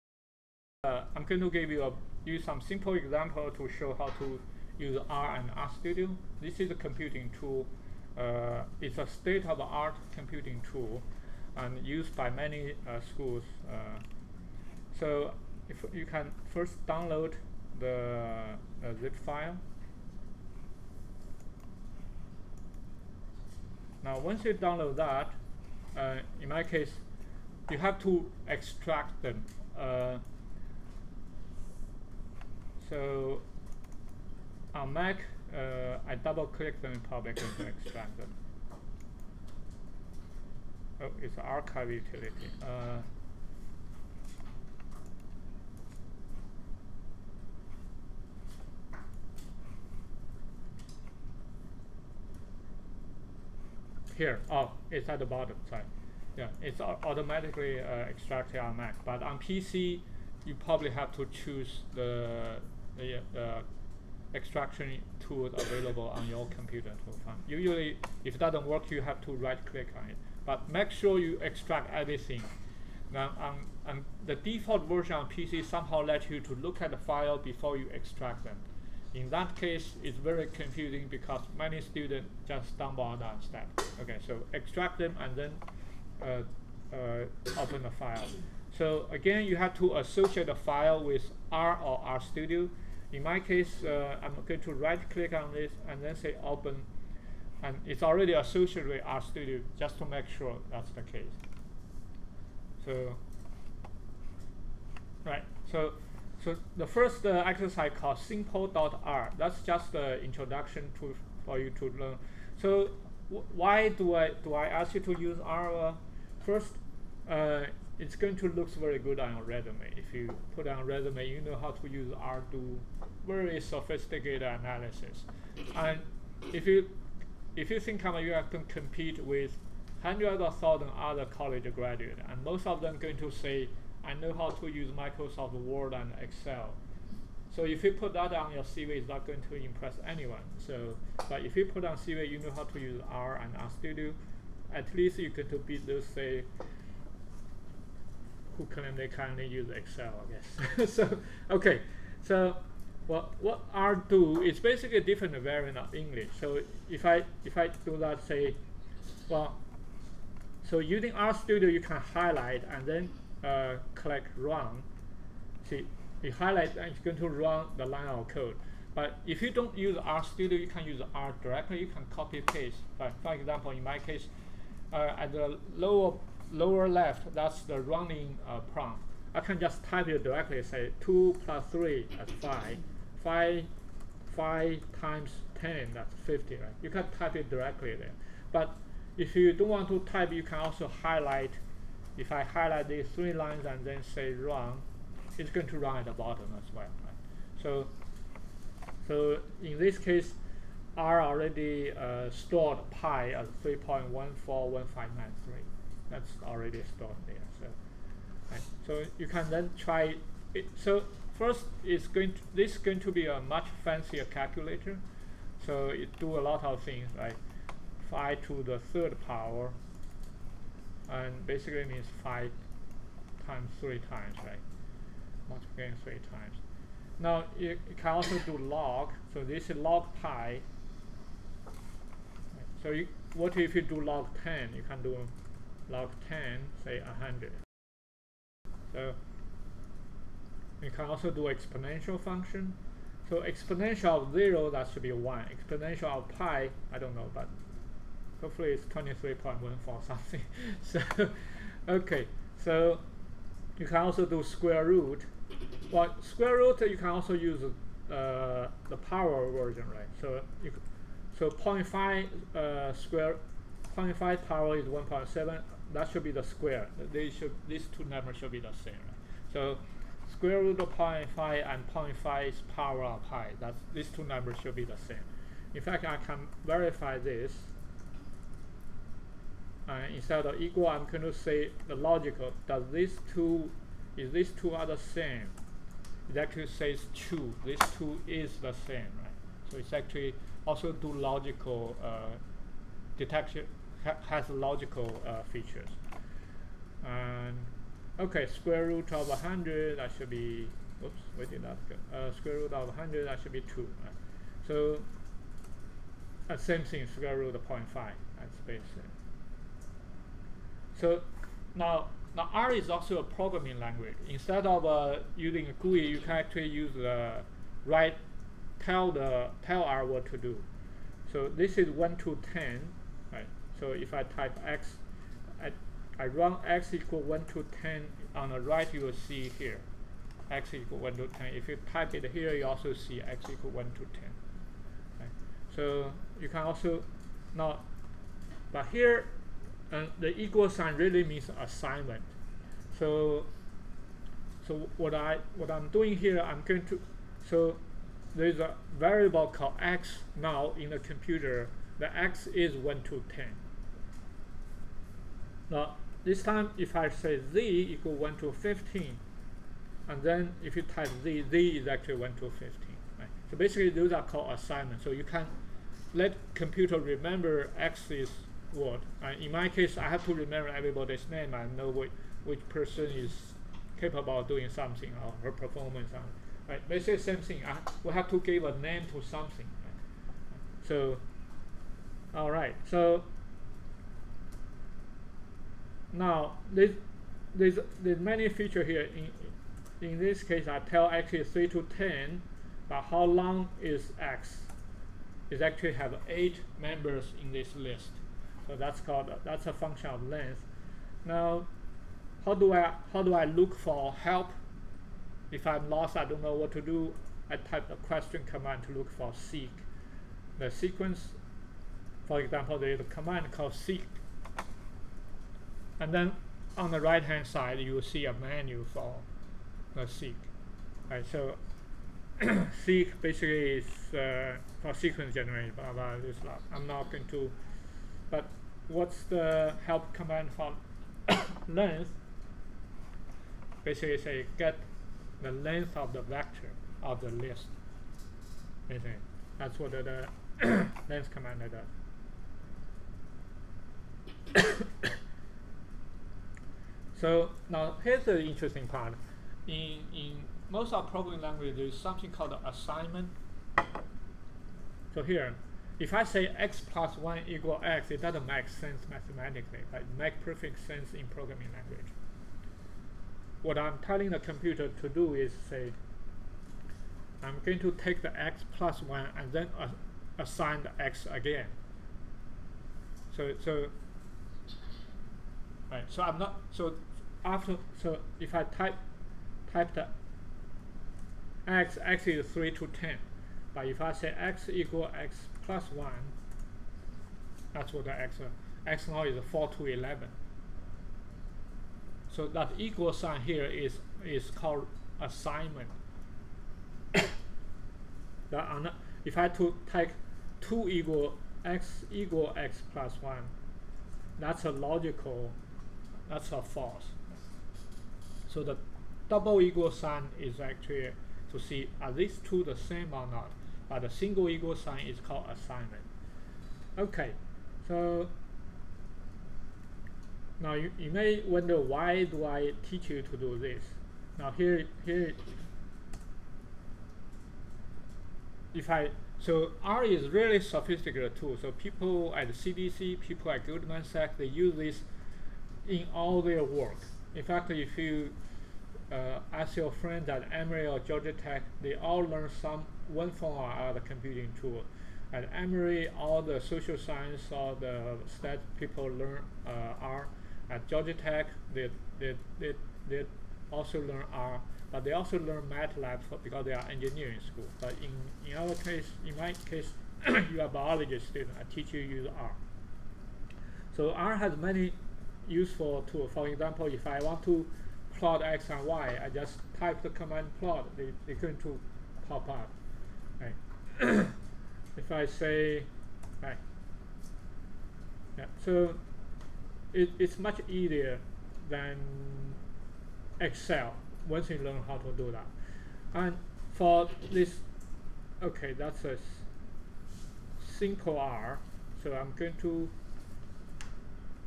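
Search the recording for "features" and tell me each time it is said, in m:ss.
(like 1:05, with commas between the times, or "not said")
4:55, 6:28.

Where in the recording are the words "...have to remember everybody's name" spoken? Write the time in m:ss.
6:10.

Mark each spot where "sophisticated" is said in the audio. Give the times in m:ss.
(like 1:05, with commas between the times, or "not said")
2:03, 8:50.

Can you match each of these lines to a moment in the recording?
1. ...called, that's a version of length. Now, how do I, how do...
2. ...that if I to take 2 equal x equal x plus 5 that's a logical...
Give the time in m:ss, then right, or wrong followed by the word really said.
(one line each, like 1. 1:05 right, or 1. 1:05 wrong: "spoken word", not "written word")
1. 6:39 wrong: "function", not "version"
2. 8:17 wrong: "1", not "5".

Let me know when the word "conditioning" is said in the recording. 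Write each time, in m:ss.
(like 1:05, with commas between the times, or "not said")
not said.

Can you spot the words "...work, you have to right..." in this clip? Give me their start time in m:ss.
1:08.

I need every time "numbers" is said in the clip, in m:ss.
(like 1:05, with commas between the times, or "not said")
4:28, 4:34.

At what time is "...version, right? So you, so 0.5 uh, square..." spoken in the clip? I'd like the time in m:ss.
4:19.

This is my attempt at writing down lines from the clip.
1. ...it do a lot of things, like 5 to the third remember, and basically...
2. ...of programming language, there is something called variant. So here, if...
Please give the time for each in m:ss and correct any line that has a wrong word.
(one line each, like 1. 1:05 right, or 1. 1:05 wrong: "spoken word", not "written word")
1. 3:35 wrong: "power", not "remember"
2. 7:30 wrong: "assignment", not "variant".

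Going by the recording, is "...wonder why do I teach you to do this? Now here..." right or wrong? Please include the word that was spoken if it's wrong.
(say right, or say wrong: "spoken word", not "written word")
right.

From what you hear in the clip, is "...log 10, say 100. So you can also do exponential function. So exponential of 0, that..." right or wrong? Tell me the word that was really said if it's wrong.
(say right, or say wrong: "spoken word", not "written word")
right.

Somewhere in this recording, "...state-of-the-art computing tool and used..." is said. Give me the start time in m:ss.
0:09.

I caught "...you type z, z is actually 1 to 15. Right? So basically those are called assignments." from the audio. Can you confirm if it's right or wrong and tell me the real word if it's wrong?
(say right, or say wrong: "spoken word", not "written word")
right.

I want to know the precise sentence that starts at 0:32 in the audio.
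So on Mac, uh, I double click them in public and extract them.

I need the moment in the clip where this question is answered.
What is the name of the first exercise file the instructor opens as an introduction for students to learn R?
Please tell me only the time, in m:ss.
1:48.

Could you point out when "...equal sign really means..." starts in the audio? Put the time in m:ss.
5:40.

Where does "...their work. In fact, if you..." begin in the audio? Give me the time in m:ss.
8:56.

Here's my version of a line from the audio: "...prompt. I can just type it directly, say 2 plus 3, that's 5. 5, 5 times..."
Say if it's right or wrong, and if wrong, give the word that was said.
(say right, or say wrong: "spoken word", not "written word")
right.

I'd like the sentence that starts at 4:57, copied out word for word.
And okay, square root of 100, that should be, oops, where did that go?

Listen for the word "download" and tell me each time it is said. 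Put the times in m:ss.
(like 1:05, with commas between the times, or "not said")
0:16, 0:24.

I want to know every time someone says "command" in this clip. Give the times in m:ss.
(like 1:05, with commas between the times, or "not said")
6:48, 6:53, 7:10, 7:21, 9:30.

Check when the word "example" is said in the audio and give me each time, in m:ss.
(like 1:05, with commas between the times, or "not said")
0:02, 2:53, 6:52, 9:26.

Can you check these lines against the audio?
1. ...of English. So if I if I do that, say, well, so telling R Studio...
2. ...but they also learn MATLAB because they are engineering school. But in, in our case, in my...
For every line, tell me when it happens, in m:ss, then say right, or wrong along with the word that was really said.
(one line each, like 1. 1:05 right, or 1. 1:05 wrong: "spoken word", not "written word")
1. 2:35 wrong: "using", not "telling"
2. 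9:14 right.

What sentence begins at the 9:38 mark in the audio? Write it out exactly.
Yeah, so it, it's much easier than Excel once you learn how to do that.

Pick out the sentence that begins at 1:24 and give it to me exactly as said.
Okay, so extract them and then uh, uh, open the file.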